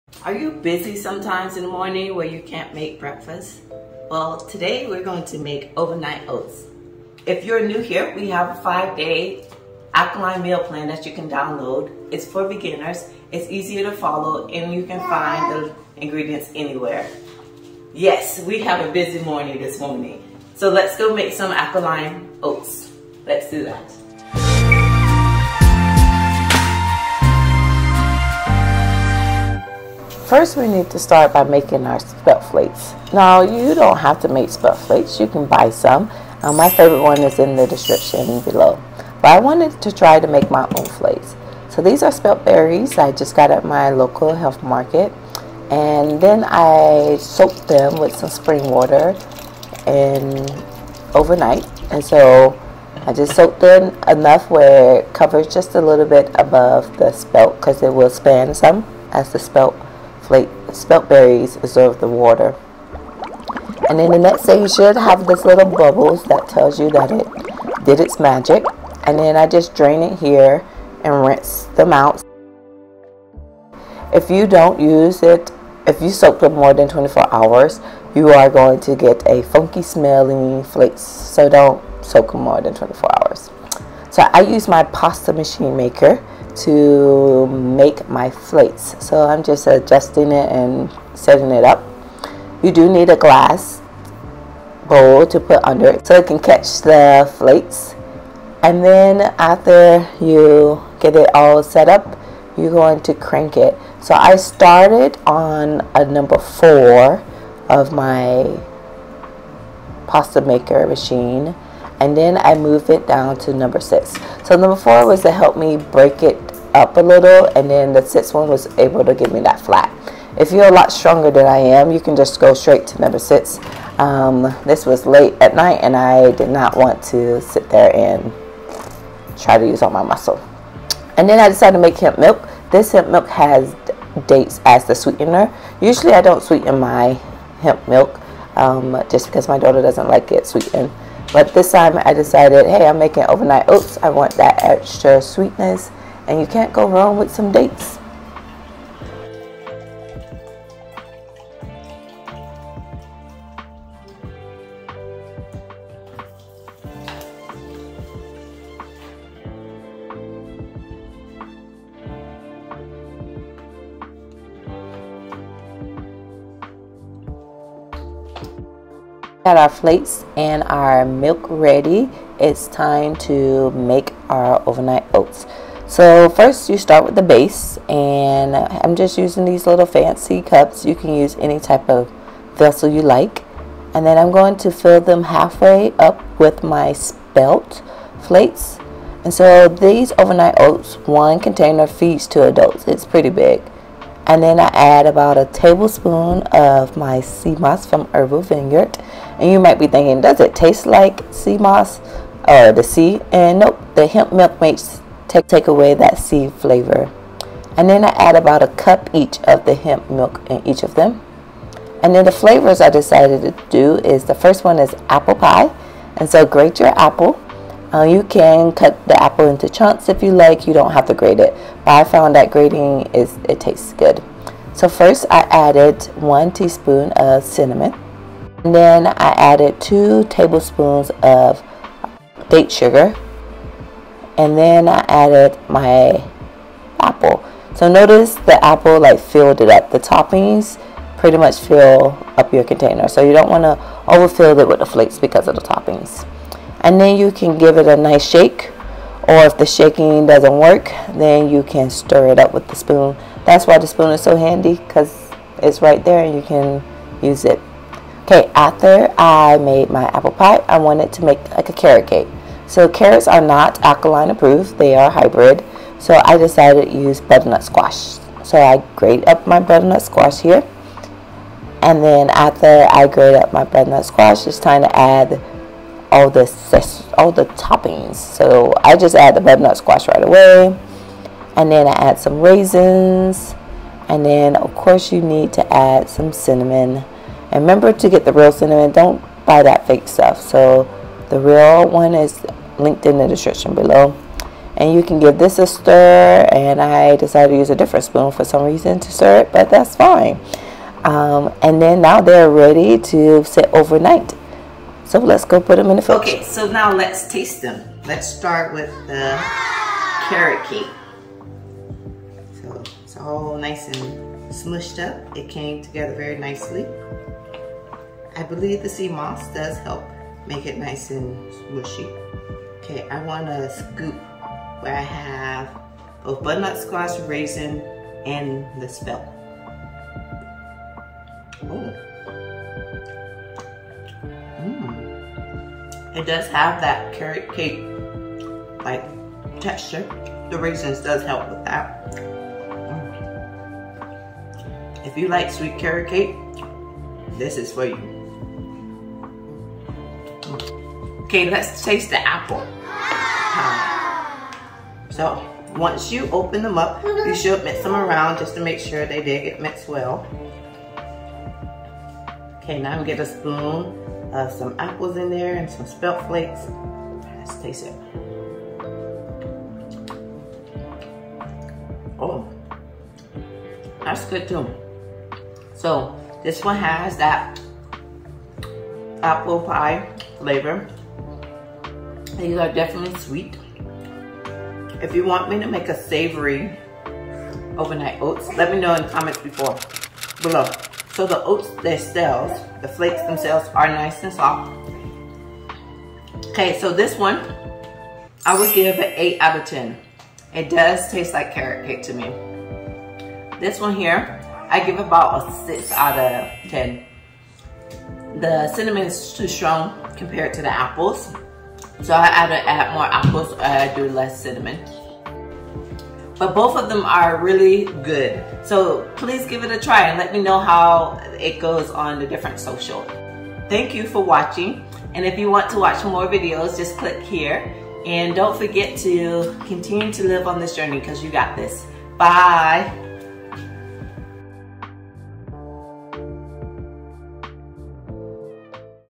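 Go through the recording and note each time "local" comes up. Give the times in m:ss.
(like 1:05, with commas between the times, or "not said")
0:43.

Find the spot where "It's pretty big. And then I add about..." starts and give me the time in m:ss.
3:12.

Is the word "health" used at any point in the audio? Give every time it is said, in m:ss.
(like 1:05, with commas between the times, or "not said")
0:44.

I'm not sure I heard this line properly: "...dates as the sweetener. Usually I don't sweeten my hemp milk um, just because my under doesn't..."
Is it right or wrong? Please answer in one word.
wrong.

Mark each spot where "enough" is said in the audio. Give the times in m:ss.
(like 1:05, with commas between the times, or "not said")
0:54.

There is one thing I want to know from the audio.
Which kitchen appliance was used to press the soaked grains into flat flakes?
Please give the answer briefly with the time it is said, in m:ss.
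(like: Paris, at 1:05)
Pasta machine, at 1:24.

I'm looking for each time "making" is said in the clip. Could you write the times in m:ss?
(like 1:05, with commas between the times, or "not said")
0:31, 2:22.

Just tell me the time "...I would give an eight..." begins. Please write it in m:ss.
6:38.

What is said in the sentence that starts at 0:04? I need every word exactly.
Well, today we're going to make overnight oats.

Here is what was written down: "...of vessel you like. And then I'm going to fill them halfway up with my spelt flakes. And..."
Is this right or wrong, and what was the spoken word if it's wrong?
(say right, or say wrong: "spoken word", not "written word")
right.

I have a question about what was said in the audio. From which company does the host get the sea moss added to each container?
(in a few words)
Herbal Vineyard.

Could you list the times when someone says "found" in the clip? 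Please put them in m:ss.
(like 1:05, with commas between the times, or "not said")
3:42.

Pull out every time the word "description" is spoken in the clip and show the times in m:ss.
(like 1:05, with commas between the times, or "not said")
0:37, 4:53.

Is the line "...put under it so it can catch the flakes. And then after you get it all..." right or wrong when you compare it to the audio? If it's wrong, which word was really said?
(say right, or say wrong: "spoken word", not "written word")
right.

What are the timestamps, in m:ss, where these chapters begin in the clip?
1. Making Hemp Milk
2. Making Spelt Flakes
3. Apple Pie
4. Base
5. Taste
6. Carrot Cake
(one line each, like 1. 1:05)
1. 2:10
2. 0:30
3. 3:34
4. 2:53
5. 5:07
6. 4:17.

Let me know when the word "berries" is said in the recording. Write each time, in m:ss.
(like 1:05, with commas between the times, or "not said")
0:42, 1:01.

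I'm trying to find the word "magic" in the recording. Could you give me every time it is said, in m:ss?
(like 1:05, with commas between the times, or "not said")
1:08.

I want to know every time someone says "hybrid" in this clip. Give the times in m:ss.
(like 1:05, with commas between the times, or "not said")
4:25.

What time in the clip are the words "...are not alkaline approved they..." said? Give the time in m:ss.
4:23.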